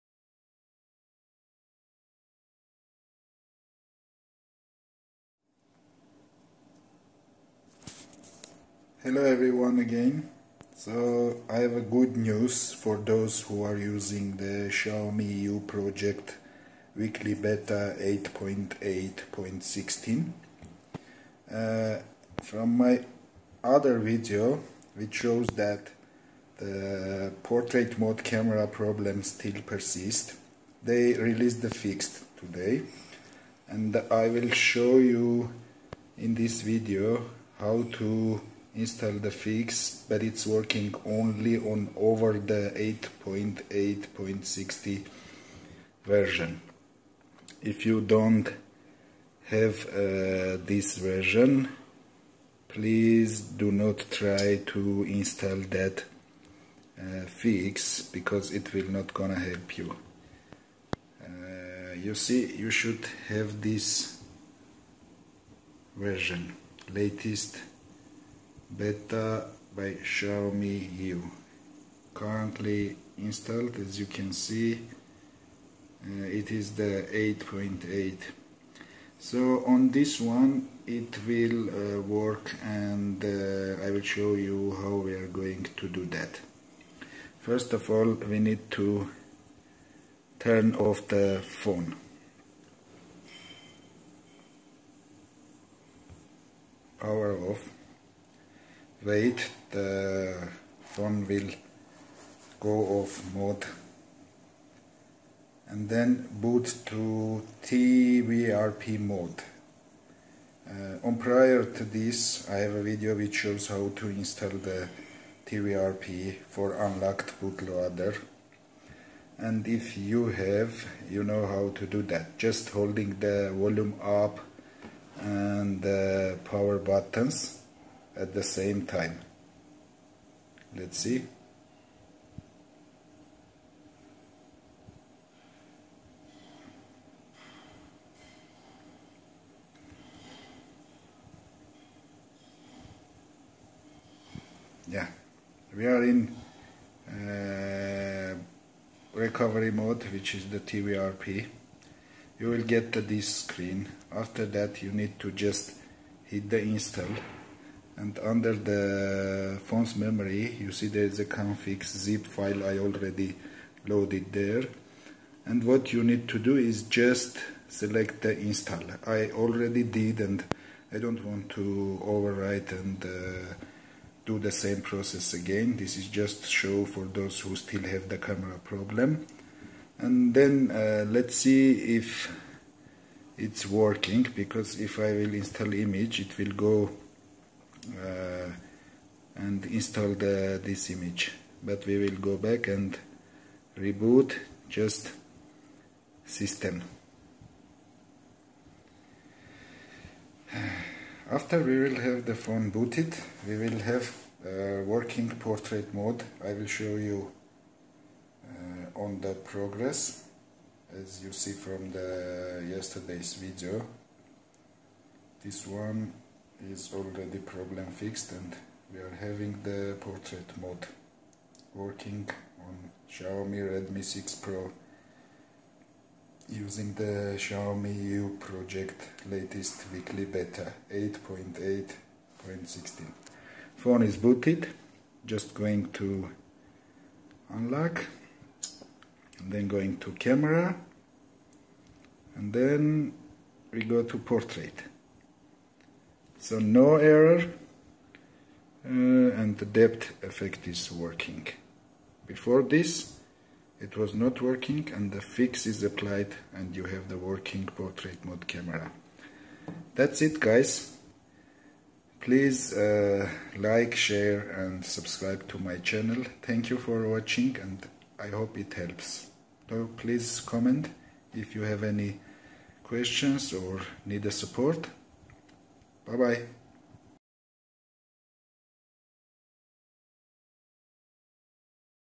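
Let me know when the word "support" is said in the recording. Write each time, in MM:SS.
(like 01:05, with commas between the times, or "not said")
04:34.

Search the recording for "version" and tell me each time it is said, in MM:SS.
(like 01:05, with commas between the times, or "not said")
00:46, 00:50, 01:05.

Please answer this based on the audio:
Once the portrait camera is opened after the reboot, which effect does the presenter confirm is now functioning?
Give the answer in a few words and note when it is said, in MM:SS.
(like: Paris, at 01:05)
depth effect, at 04:09.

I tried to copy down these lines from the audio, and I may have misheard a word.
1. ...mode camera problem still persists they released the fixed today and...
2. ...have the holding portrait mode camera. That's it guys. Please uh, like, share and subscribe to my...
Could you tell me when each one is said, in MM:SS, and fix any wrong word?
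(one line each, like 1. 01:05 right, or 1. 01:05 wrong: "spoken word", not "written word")
1. 00:27 right
2. 04:16 wrong: "working", not "holding".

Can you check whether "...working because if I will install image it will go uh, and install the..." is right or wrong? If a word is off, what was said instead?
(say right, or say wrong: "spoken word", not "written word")
right.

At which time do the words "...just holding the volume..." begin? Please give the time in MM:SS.
02:02.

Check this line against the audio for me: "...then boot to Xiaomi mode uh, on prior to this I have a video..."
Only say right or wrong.
wrong.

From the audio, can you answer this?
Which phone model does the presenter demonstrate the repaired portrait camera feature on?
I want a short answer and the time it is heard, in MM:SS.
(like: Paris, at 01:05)
Xiaomi Redmi 6 Pro, at 03:43.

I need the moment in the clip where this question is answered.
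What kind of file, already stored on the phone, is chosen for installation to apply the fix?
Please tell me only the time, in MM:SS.
02:41.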